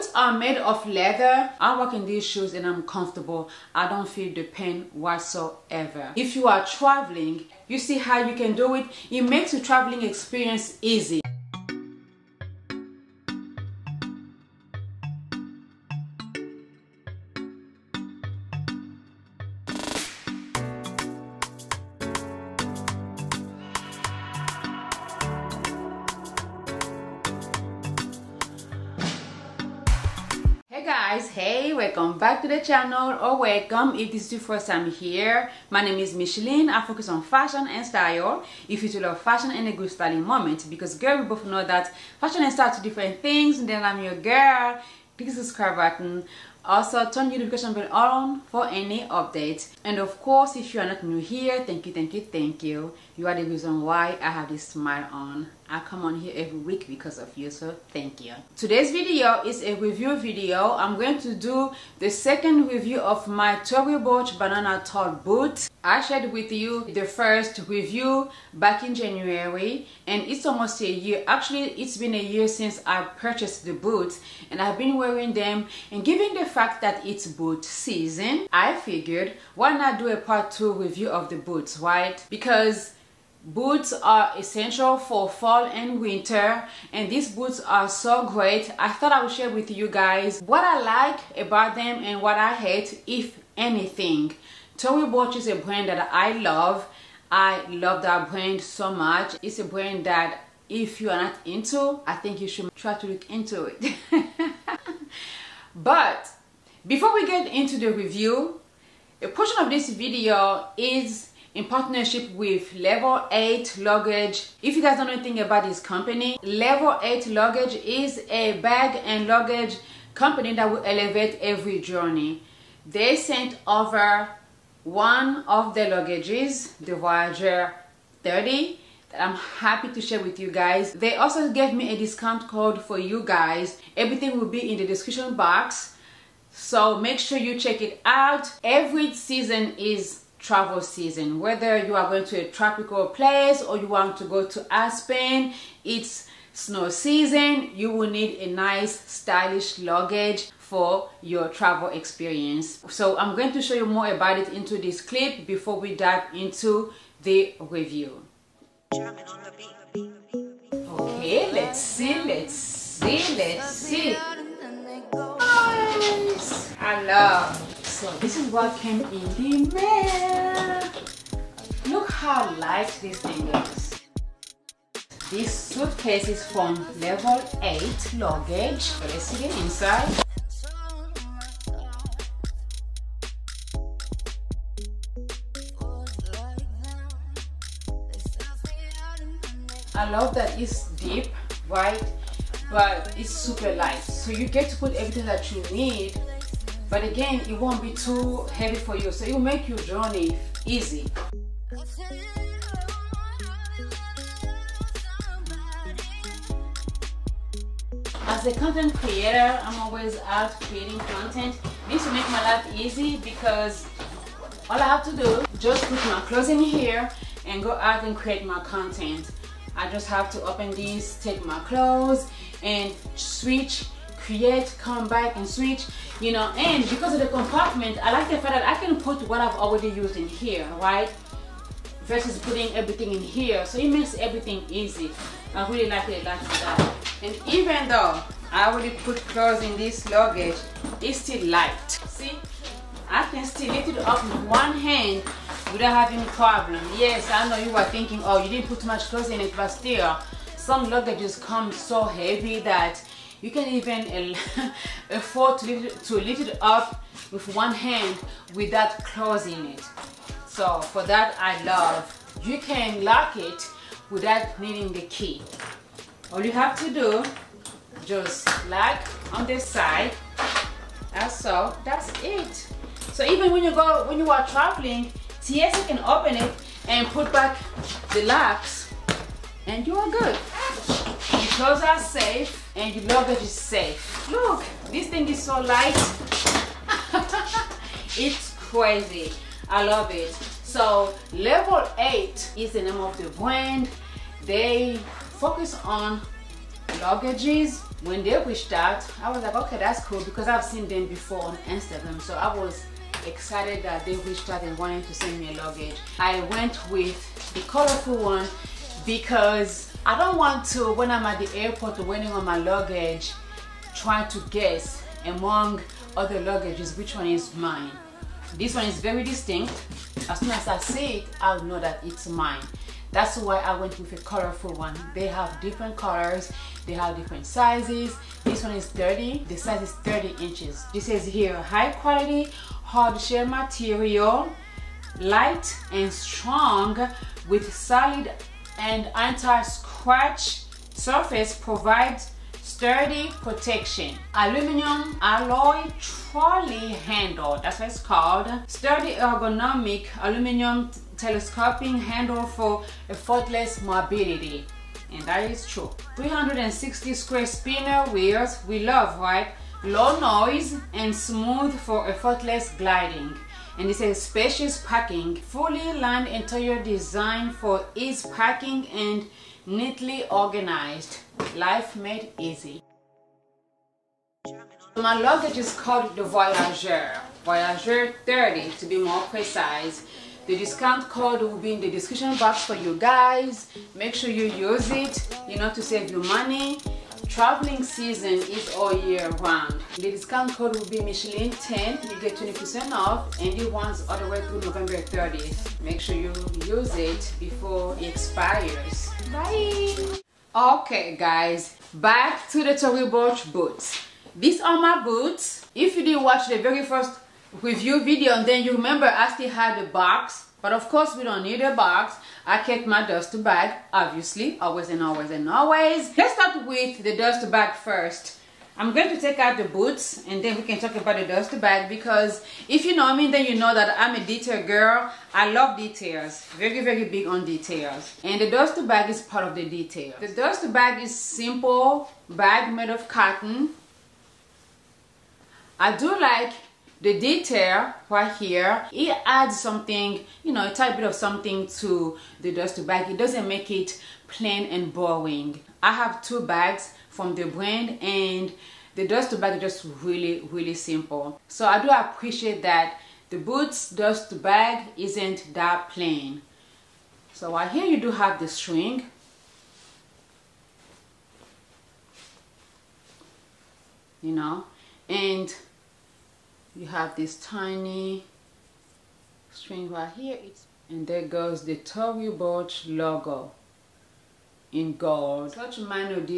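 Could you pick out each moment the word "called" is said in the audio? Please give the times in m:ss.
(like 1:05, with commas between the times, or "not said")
5:48, 6:15.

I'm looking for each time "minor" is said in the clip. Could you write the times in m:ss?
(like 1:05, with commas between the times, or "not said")
7:55.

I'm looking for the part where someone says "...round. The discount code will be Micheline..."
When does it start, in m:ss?
6:29.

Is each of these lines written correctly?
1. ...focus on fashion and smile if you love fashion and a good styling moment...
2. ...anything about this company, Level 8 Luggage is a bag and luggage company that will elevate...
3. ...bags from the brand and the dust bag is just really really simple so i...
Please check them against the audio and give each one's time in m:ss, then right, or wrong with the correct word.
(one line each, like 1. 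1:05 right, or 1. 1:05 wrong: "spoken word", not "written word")
1. 0:36 wrong: "style", not "smile"
2. 1:55 right
3. 7:26 right.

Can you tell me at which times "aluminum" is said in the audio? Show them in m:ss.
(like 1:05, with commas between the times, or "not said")
5:44, 5:50.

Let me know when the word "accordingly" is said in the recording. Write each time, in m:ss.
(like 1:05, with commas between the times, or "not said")
not said.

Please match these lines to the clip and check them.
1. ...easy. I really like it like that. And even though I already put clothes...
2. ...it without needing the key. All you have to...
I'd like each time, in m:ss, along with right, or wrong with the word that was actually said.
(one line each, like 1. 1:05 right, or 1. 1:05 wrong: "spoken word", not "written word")
1. 3:54 right
2. 4:23 right.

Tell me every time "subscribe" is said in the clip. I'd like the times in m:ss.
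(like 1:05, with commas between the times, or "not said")
0:45.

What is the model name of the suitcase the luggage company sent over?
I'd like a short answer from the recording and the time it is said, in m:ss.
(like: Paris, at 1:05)
Voyager 30, at 2:06.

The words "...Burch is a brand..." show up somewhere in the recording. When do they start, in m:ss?
1:35.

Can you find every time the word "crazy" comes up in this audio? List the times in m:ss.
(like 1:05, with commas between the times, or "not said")
4:48.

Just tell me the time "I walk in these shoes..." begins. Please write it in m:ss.
0:01.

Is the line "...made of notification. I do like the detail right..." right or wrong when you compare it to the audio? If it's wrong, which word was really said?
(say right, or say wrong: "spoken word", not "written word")
wrong: "cotton", not "notification".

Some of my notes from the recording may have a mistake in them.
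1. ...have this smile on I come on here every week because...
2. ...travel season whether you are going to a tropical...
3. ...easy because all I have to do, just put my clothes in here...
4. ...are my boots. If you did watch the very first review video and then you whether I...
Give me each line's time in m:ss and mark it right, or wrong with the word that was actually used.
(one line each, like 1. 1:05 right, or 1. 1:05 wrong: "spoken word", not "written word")
1. 0:54 right
2. 2:20 right
3. 3:32 right
4. 6:44 wrong: "remember", not "whether".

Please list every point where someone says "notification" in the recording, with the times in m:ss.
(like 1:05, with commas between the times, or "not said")
0:47.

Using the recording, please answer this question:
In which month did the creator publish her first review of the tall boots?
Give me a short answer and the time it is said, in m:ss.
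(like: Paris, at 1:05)
January, at 1:08.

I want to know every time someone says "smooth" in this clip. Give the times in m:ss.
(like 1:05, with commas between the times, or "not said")
6:01.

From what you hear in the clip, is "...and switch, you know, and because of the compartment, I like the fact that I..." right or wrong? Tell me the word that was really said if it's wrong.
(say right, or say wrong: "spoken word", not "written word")
right.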